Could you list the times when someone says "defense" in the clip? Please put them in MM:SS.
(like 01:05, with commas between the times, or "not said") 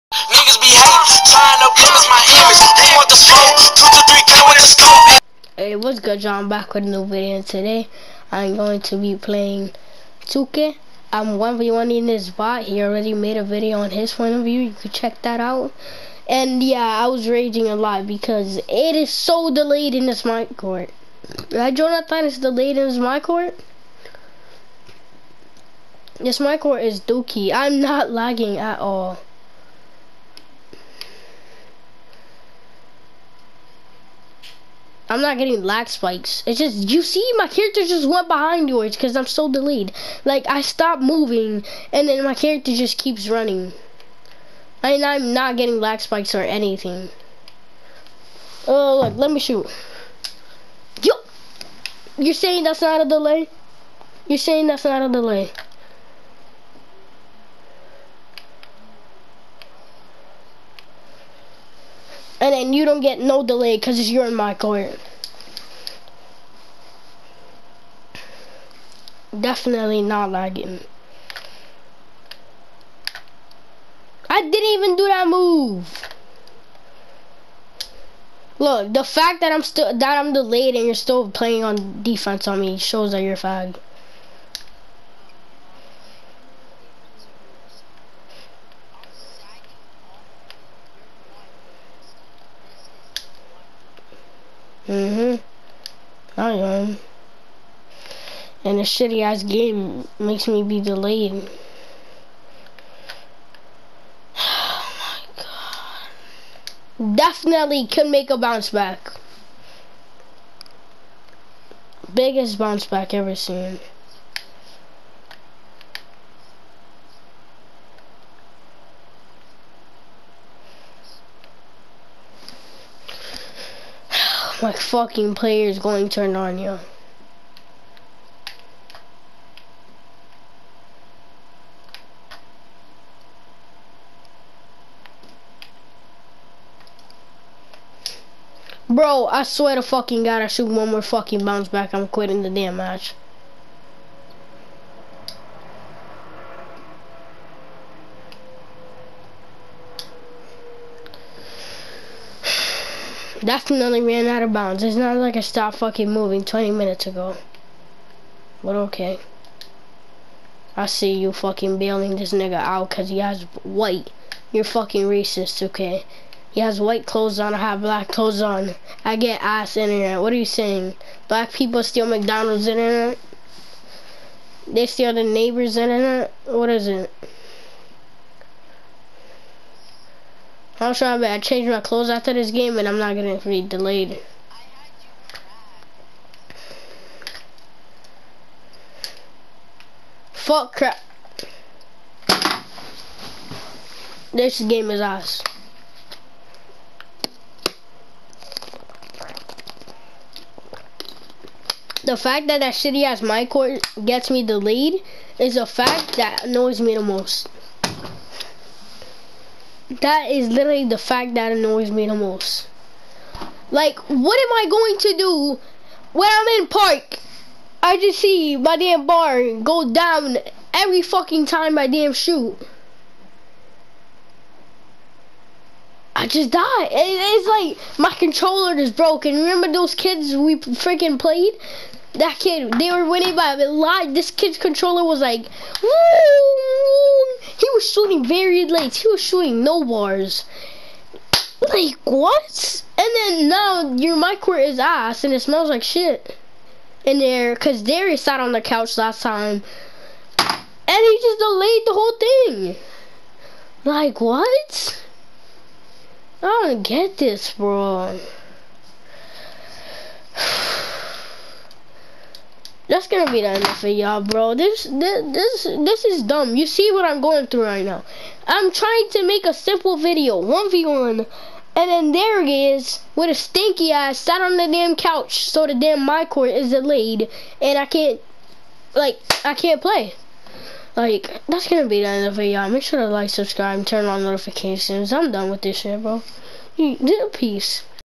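01:22.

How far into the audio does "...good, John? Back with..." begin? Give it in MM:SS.
00:05.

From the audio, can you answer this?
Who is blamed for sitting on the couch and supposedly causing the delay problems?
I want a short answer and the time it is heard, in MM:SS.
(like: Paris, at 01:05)
Darius, at 04:07.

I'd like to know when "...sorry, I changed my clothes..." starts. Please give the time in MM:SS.
03:00.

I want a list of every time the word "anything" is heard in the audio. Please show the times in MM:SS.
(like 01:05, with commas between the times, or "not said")
00:46.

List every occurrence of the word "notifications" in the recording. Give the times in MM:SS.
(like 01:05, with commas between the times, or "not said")
04:44.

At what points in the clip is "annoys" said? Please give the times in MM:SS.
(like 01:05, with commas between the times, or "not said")
03:26, 03:31.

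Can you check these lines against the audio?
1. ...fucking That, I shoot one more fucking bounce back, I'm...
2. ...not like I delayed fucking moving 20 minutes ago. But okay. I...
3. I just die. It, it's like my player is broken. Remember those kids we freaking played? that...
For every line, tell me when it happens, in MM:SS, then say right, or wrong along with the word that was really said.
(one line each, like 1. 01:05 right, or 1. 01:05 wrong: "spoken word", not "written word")
1. 02:19 wrong: "God", not "That"
2. 02:34 wrong: "stopped", not "delayed"
3. 03:46 wrong: "controller", not "player".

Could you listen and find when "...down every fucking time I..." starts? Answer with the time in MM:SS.
03:39.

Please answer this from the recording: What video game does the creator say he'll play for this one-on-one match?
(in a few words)
2K.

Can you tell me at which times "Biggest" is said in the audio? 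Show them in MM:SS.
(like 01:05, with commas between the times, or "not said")
01:52.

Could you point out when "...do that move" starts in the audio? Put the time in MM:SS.
01:14.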